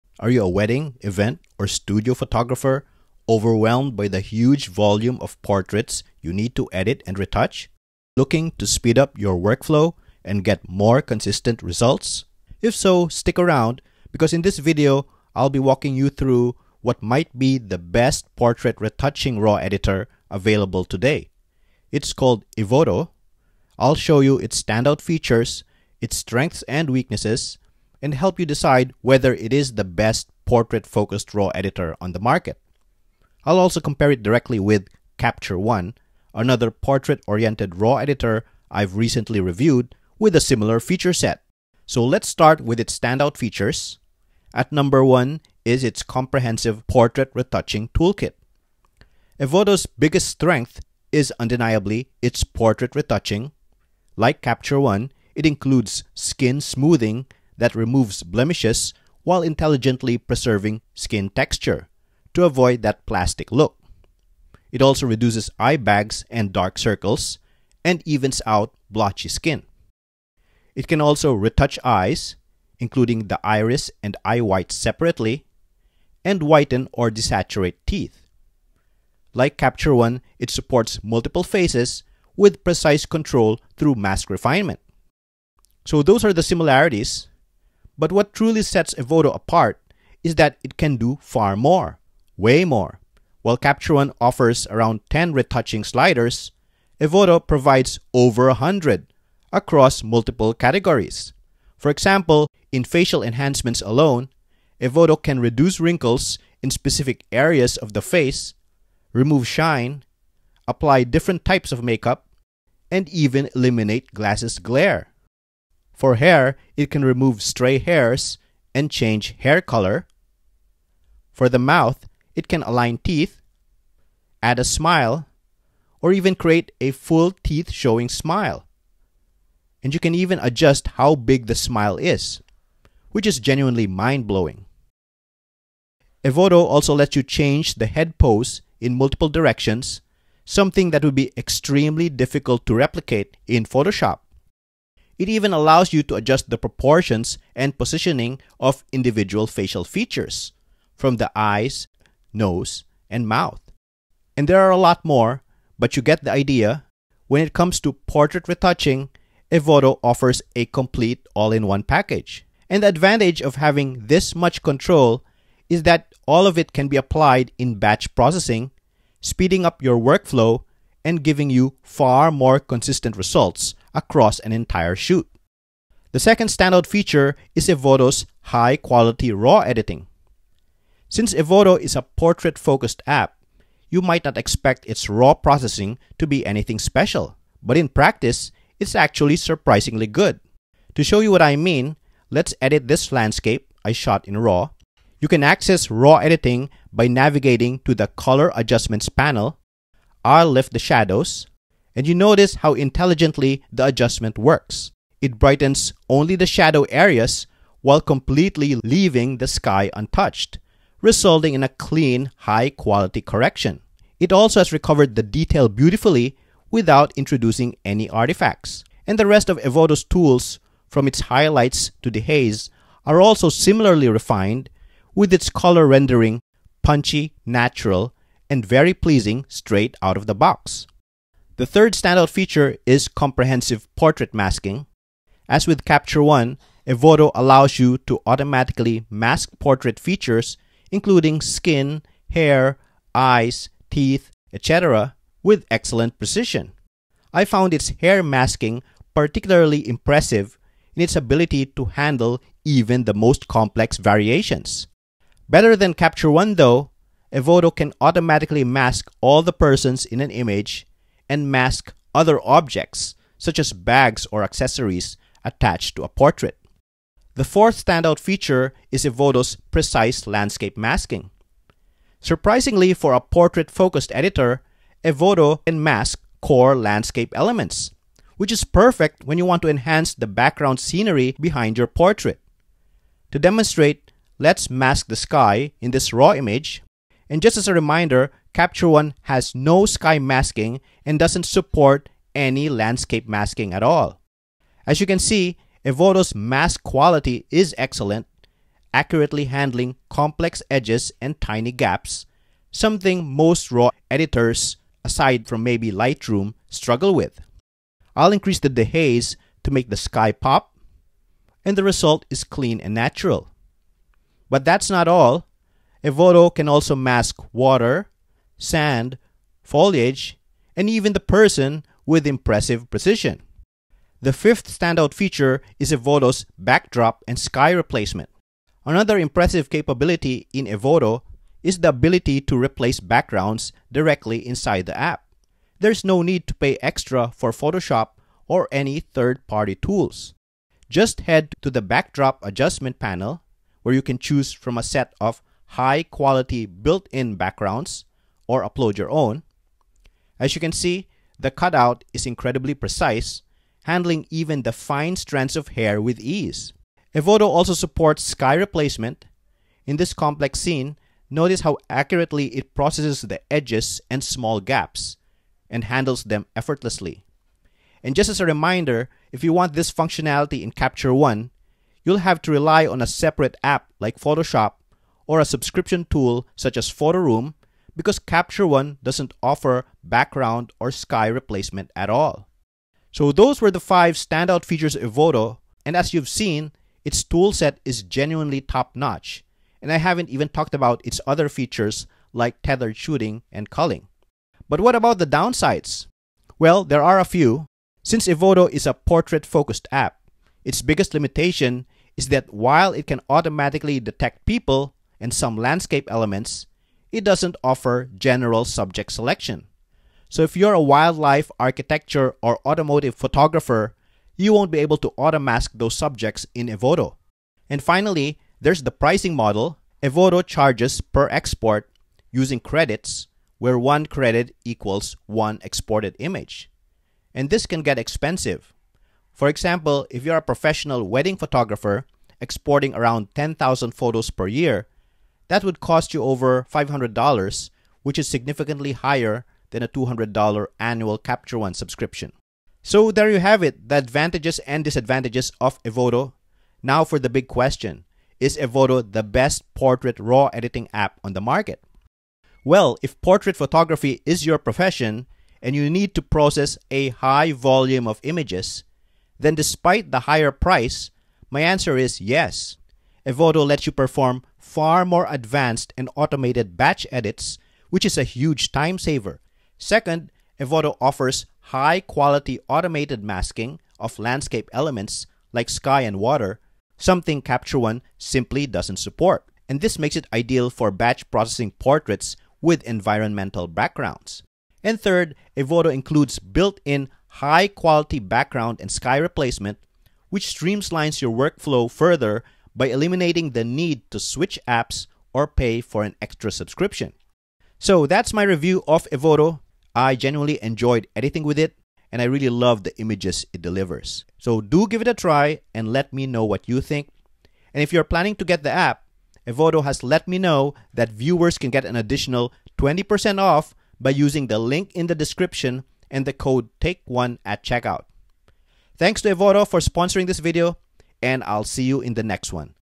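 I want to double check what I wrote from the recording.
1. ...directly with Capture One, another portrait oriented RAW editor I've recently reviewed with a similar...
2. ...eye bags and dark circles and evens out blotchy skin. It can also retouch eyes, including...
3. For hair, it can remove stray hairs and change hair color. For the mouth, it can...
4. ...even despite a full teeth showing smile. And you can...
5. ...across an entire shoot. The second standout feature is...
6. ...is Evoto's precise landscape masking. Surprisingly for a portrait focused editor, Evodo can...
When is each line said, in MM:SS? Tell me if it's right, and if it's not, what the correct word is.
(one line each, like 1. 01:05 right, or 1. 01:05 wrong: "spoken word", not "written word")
1. 00:34 right
2. 01:05 right
3. 01:56 right
4. 02:06 wrong: "create", not "despite"
5. 02:53 right
6. 04:28 right.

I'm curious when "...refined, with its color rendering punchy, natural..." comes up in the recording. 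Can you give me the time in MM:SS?
03:44.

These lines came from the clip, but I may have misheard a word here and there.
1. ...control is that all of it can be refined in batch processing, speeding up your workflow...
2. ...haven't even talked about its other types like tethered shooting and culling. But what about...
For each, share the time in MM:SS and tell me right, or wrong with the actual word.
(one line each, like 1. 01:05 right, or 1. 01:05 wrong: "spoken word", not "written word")
1. 02:44 wrong: "applied", not "refined"
2. 06:29 wrong: "features", not "types".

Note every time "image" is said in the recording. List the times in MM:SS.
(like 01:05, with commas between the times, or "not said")
04:20, 04:46, 07:06, 07:38, 08:22.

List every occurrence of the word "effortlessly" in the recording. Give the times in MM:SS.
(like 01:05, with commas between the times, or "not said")
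06:06.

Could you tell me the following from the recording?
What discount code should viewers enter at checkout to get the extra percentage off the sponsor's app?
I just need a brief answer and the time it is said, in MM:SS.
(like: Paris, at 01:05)
TAKE1, at 08:36.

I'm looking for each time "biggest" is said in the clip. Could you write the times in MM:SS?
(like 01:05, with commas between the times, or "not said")
00:49, 06:40.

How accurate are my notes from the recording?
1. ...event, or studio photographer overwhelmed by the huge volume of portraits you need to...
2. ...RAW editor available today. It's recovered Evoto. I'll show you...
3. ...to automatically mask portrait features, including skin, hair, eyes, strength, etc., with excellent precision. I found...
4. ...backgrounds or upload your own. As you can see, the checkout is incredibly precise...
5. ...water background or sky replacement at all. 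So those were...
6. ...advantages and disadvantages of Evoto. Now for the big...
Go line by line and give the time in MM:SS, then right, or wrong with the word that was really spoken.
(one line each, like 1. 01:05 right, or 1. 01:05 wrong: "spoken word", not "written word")
1. 00:01 right
2. 00:19 wrong: "called", not "recovered"
3. 03:58 wrong: "teeth", not "strength"
4. 05:47 wrong: "cutout", not "checkout"
5. 06:19 wrong: "offer", not "water"
6. 07:23 right.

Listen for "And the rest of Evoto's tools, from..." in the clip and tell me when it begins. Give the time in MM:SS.
03:39.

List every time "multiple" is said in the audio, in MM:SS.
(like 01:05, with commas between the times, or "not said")
01:21, 01:40, 02:18.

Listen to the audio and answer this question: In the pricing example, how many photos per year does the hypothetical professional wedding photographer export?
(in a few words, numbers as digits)
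10,000.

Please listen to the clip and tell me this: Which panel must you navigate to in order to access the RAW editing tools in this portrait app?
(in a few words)
Color Adjustments.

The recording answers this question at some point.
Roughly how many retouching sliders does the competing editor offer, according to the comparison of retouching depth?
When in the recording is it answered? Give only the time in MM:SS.
01:34.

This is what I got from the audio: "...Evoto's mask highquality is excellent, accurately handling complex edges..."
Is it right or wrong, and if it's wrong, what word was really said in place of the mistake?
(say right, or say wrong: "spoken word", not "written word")
wrong: "quality", not "highquality".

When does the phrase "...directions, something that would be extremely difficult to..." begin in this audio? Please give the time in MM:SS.
02:19.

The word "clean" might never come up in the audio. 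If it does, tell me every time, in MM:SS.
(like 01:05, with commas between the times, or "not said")
03:31, 05:12.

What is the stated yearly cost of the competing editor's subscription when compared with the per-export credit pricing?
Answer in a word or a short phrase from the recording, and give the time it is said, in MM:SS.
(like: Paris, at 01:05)
$200, at 07:19.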